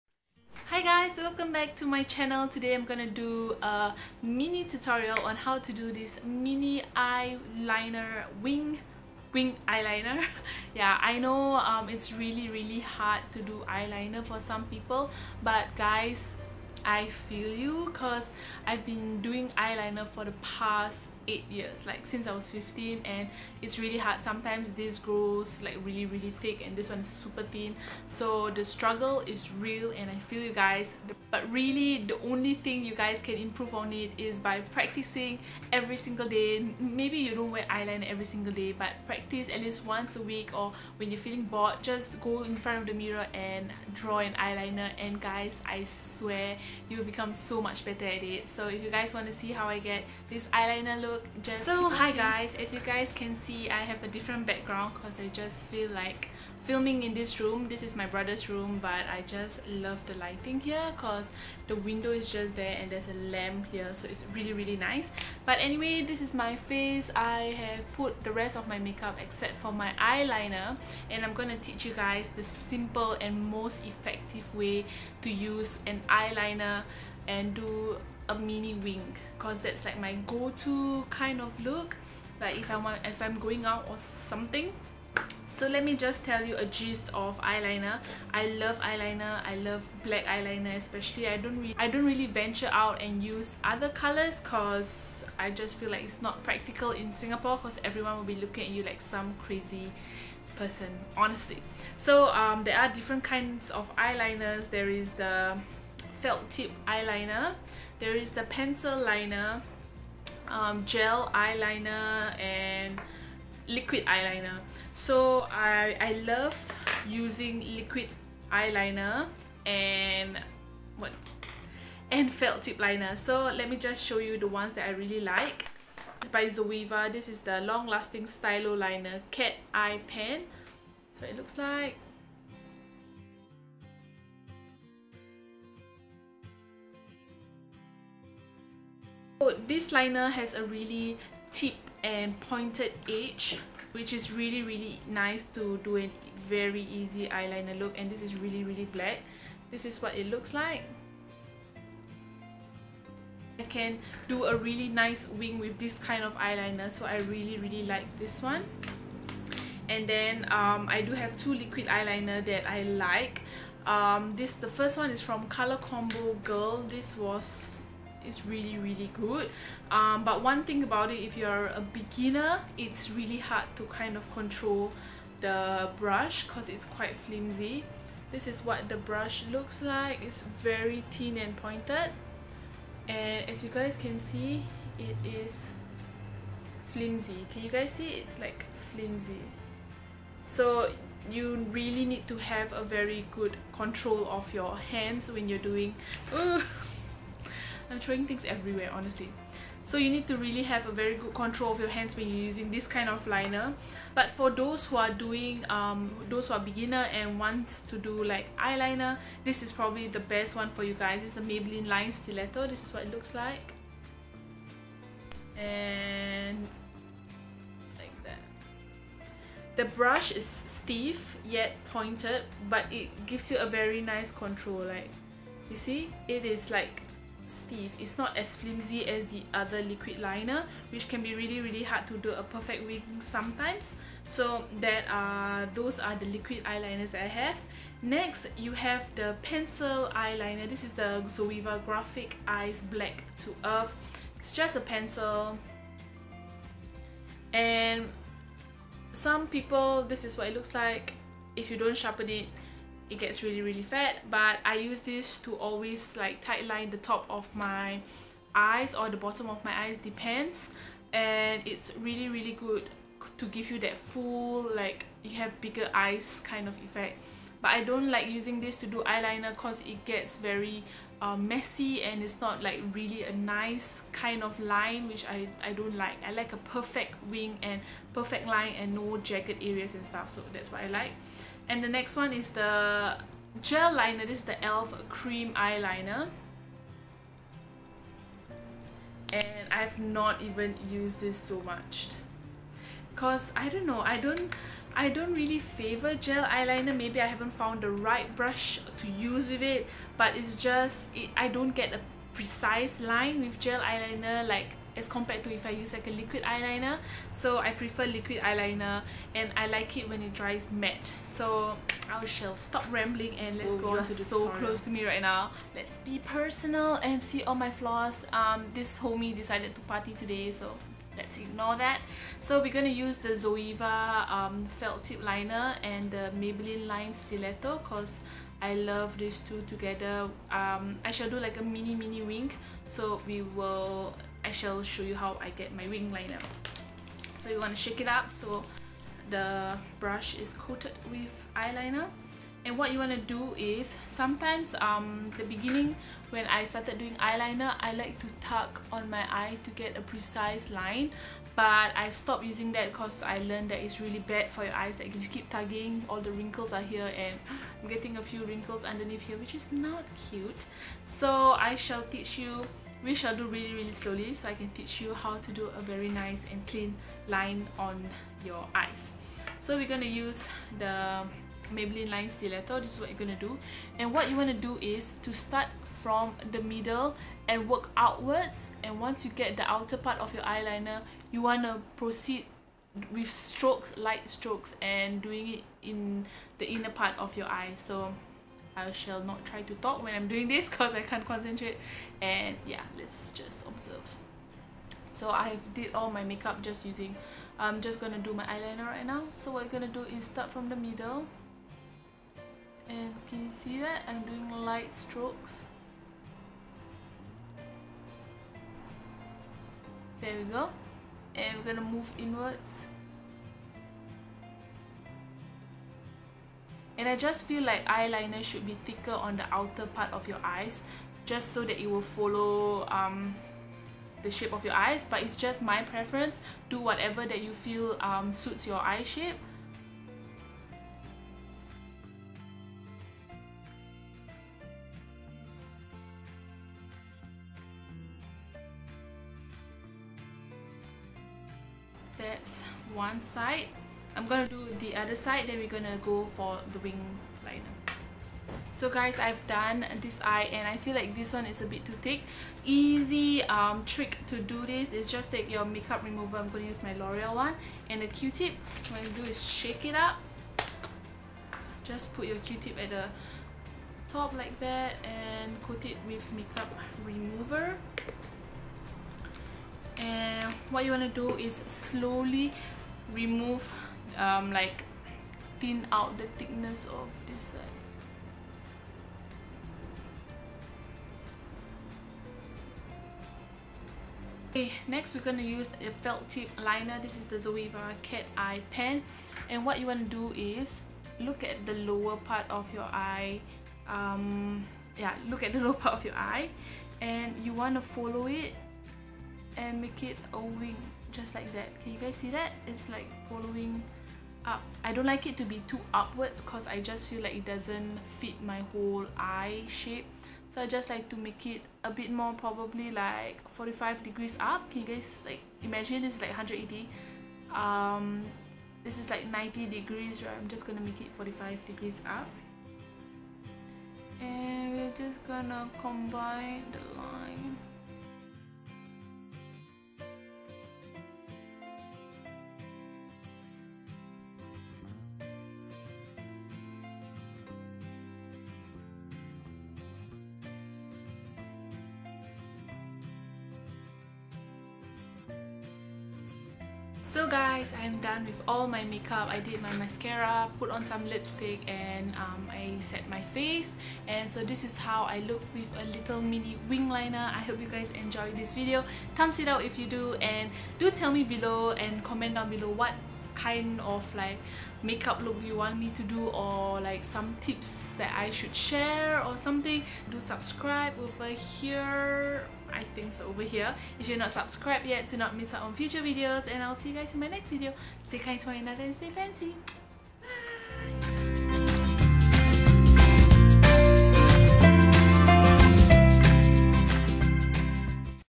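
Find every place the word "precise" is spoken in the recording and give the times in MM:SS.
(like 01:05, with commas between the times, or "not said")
05:02, 05:50.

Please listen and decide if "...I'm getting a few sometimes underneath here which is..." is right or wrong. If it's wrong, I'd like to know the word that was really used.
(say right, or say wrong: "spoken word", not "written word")
wrong: "wrinkles", not "sometimes".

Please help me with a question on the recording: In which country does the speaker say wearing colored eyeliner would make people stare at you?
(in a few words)
Singapore.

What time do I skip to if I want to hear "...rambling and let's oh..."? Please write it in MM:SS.
05:12.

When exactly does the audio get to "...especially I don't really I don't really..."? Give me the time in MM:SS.
01:30.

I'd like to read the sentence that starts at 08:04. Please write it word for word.
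Okay, next we're gonna use a felt tip liner.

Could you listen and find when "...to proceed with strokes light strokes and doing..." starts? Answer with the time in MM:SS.
06:21.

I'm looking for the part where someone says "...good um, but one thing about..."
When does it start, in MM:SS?
02:49.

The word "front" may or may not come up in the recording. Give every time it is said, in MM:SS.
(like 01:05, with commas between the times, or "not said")
00:42.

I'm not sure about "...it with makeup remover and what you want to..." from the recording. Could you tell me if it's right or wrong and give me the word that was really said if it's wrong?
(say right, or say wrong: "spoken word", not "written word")
right.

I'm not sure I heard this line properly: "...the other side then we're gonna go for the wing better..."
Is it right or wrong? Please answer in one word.
wrong.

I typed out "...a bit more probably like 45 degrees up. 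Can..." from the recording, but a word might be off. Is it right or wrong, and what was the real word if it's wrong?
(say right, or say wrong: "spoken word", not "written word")
right.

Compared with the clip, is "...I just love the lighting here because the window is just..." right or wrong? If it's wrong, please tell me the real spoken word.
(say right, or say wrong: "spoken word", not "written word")
right.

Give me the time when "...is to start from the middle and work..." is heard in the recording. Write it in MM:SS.
06:14.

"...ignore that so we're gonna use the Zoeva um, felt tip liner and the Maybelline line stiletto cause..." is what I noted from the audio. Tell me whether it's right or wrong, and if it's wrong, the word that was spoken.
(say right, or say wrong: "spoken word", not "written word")
right.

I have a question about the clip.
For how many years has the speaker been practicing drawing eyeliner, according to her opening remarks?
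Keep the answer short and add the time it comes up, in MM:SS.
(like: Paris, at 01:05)
8, at 00:21.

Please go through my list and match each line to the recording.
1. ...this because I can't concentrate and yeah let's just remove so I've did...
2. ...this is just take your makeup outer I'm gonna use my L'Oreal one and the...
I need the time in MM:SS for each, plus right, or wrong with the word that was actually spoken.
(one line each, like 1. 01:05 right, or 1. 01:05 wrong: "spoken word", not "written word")
1. 06:30 wrong: "observe", not "remove"
2. 07:34 wrong: "remover", not "outer".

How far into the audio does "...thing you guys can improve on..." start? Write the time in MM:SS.
00:32.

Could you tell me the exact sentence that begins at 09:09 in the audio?
I did my mascara, put on some lipstick and um, I set my face.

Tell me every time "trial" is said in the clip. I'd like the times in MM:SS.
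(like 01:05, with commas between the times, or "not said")
not said.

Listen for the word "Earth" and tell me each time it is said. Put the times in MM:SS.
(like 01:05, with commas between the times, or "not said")
04:03.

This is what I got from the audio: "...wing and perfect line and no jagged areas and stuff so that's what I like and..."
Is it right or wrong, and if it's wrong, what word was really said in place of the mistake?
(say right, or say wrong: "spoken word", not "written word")
right.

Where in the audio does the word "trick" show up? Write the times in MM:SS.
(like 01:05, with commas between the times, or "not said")
07:33.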